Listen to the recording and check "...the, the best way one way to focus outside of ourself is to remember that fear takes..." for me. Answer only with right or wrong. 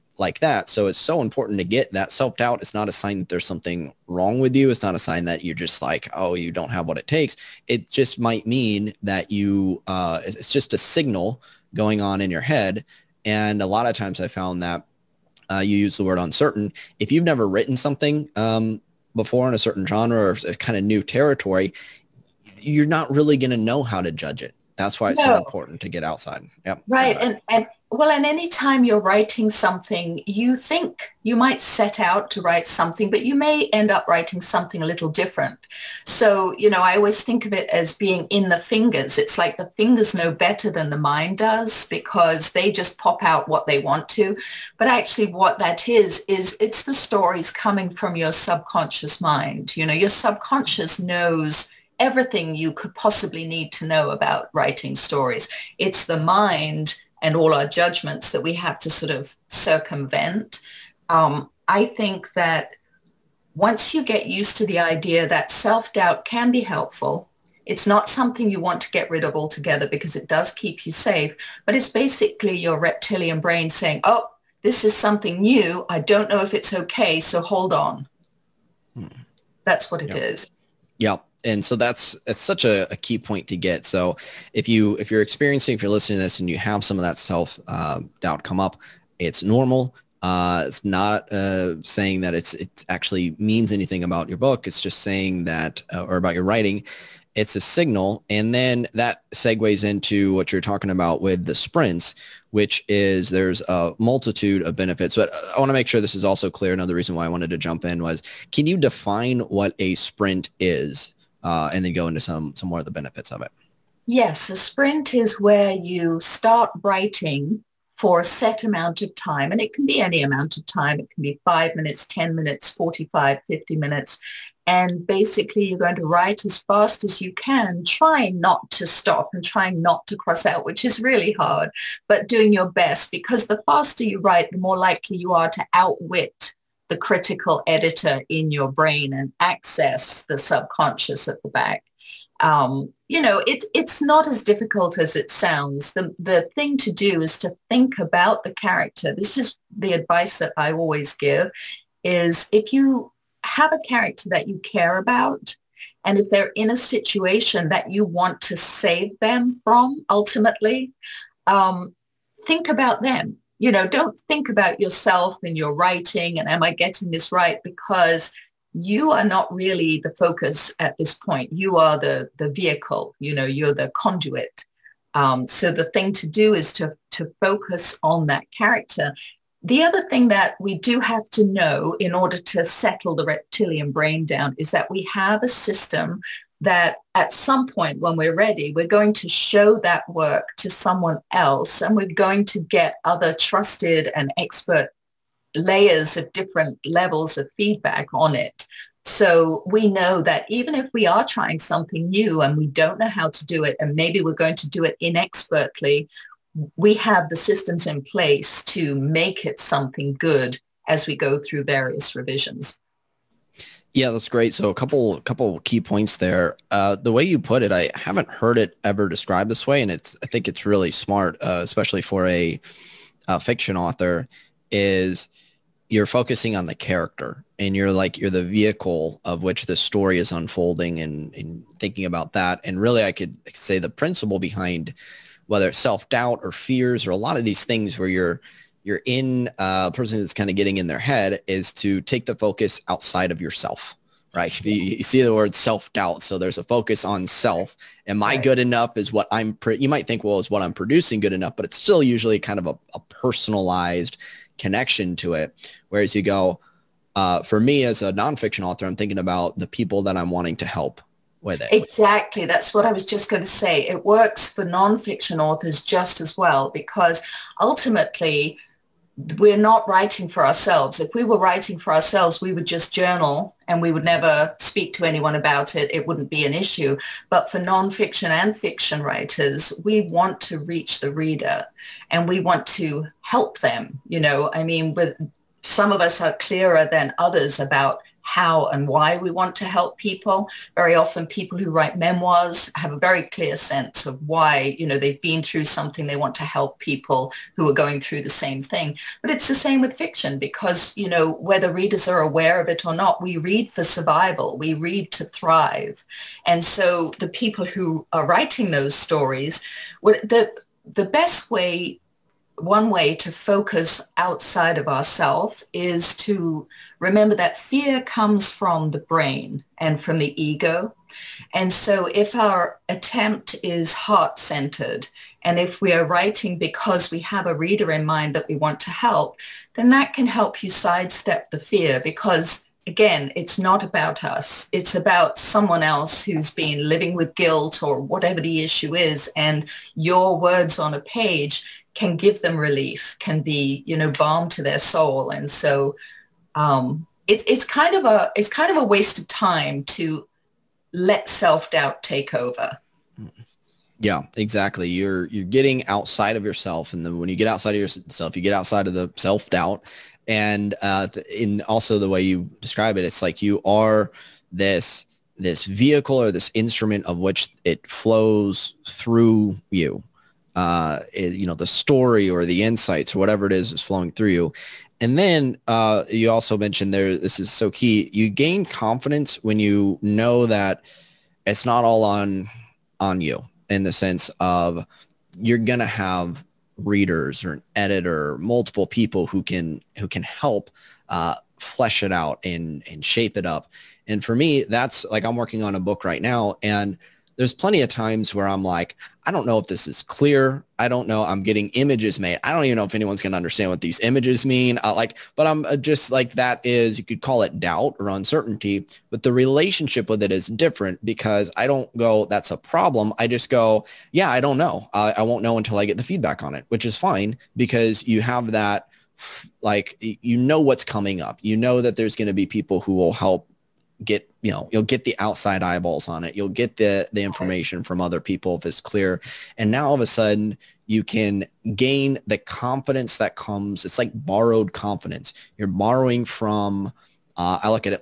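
wrong.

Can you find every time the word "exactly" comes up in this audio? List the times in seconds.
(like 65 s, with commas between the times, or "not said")
261 s, 354 s.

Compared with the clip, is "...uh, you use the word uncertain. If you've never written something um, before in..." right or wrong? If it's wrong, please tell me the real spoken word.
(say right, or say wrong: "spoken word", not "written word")
right.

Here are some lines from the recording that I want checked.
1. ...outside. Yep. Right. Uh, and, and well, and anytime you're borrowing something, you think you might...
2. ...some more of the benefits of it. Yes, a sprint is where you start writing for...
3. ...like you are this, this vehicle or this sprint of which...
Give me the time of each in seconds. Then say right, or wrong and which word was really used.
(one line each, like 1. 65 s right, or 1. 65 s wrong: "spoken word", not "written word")
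1. 26 s wrong: "writing", not "borrowing"
2. 112 s right
3. 363 s wrong: "instrument", not "sprint".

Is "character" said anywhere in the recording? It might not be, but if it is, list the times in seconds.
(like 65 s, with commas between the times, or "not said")
148 s, 153 s, 178 s, 226 s.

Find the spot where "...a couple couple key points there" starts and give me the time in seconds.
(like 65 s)
214 s.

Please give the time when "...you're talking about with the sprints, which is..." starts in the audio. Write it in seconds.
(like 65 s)
100 s.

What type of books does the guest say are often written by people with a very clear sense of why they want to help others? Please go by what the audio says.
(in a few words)
Memoirs.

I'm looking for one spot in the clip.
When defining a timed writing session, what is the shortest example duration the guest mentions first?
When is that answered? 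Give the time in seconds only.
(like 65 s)
121 s.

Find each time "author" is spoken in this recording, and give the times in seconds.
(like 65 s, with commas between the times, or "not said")
223 s, 258 s, 265 s.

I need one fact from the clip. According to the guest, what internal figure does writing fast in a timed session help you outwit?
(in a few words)
The critical editor.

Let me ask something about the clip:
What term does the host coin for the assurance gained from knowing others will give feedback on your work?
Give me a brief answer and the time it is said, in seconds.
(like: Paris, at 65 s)
Borrowed confidence, at 434 s.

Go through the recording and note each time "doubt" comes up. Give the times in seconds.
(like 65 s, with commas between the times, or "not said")
2 s, 65 s, 88 s, 235 s, 245 s, 351 s, 359 s, 407 s.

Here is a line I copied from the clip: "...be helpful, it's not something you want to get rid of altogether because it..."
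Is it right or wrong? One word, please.
right.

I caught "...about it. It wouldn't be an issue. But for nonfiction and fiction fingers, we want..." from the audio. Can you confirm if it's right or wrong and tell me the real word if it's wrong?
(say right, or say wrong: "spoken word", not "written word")
wrong: "writers", not "fingers".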